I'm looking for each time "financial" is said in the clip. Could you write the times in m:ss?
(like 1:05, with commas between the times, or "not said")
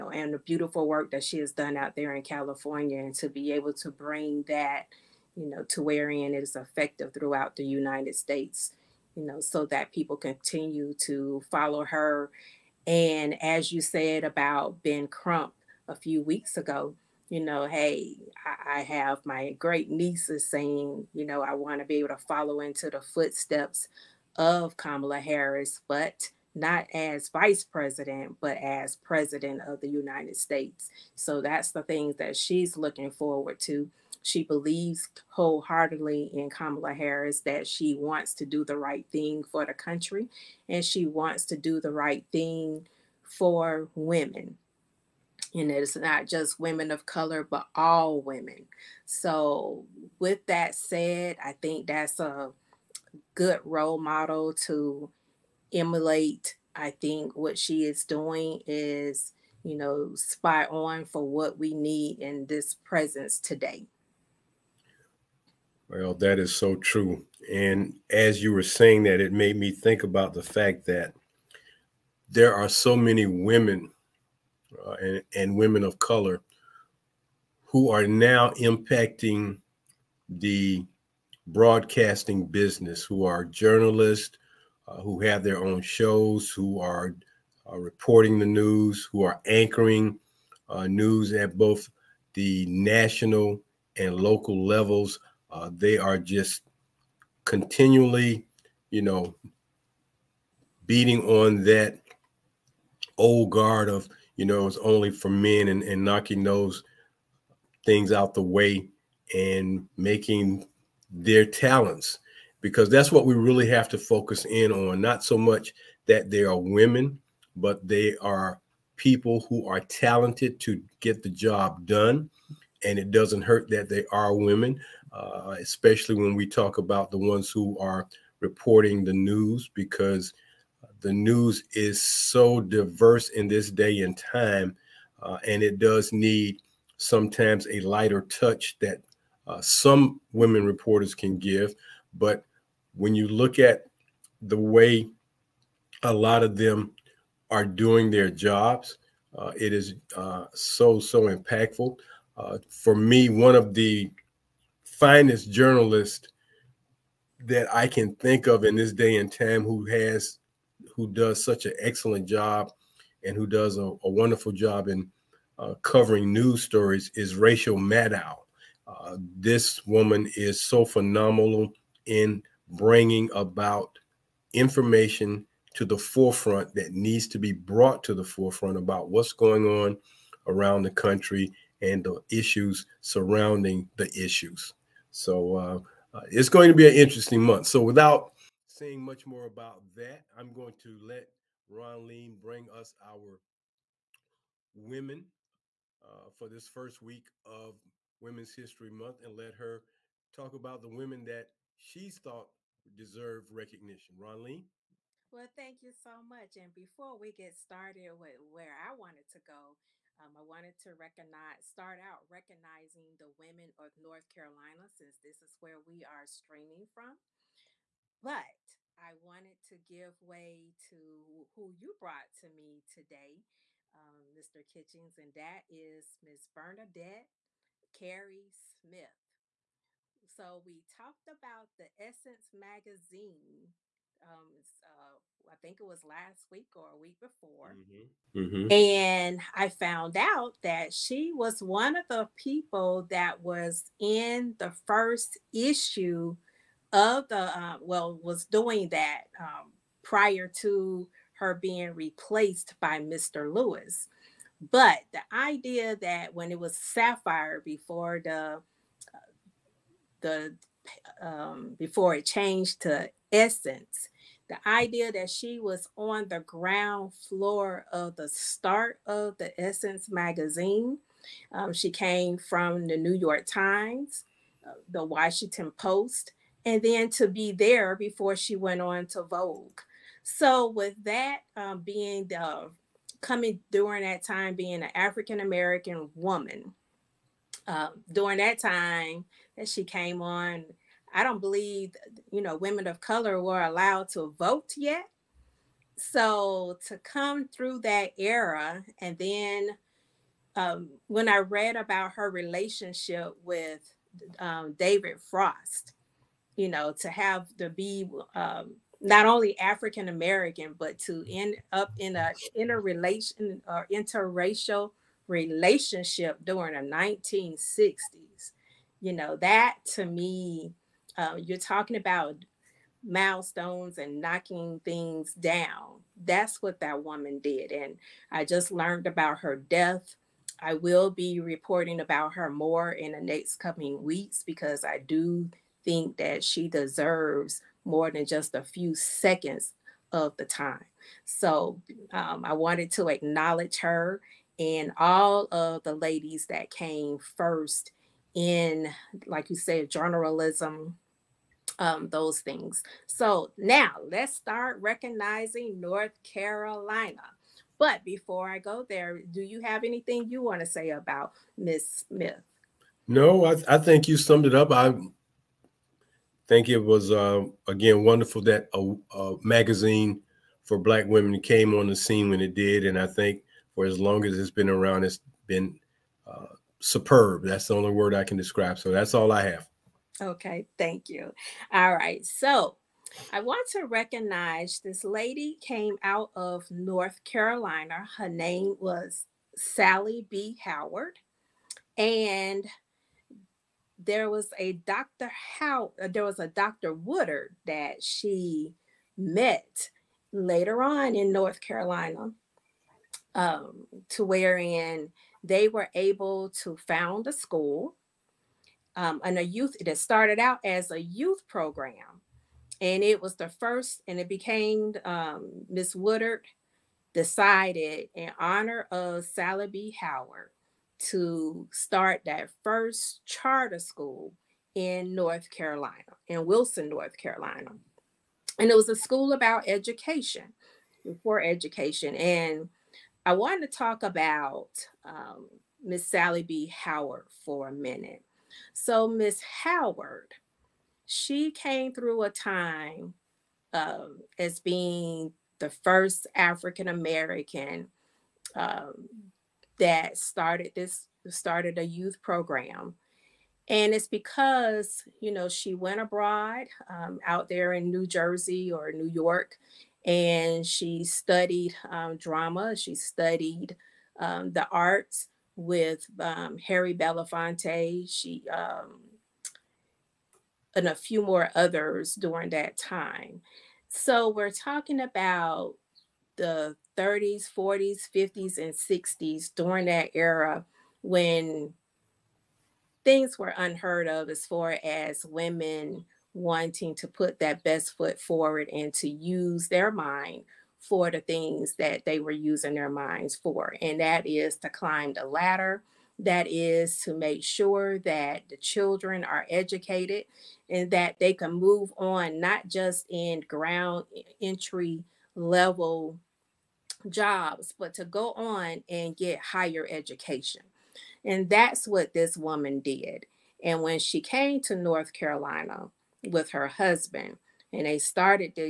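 not said.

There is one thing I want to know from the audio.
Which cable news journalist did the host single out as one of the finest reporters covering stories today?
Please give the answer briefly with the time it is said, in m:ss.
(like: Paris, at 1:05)
Rachel Maddow, at 2:47.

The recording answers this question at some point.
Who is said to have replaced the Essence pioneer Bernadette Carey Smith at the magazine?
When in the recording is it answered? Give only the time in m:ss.
4:12.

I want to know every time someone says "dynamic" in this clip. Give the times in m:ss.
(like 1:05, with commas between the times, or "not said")
not said.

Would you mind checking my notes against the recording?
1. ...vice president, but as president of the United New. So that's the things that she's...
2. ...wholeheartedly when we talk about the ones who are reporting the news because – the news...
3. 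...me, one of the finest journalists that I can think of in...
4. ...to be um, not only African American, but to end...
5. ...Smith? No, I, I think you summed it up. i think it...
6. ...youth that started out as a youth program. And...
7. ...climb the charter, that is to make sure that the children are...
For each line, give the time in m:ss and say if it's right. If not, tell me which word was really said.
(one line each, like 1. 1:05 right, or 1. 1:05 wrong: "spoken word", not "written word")
1. 0:27 wrong: "States", not "New"
2. 2:05 wrong: "especially", not "wholeheartedly"
3. 2:32 right
4. 5:07 right
5. 6:02 right
6. 6:49 right
7. 8:14 wrong: "ladder", not "charter".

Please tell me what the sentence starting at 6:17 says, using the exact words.
That's the only word I can describe.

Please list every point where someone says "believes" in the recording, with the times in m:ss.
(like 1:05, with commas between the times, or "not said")
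0:34, 4:51.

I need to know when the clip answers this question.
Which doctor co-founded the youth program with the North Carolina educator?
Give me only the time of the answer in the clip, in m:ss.
6:36.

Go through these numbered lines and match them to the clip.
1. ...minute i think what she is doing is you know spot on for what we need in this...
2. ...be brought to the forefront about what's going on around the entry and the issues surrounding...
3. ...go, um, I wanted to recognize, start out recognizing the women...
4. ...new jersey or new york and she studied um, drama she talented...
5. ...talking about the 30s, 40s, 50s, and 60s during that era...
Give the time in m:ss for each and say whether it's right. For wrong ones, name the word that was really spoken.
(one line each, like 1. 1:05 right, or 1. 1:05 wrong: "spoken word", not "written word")
1. 0:55 wrong: "emulate", not "minute"
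2. 2:57 wrong: "country", not "entry"
3. 3:29 right
4. 7:37 wrong: "studied", not "talented"
5. 7:54 right.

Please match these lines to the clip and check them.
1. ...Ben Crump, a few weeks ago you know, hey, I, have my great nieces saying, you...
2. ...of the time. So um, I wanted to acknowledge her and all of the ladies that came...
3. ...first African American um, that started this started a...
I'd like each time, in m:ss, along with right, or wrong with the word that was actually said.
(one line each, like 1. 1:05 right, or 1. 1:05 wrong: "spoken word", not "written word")
1. 0:14 right
2. 5:40 right
3. 7:25 right.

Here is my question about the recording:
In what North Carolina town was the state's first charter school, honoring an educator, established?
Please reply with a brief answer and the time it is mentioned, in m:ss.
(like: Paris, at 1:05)
Wilson, at 7:06.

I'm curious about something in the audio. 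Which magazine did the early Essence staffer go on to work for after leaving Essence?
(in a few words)
Vogue.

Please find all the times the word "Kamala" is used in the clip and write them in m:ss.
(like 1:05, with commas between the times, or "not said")
0:24, 0:36.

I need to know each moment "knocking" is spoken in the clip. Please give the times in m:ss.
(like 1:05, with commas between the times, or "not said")
1:46, 5:24.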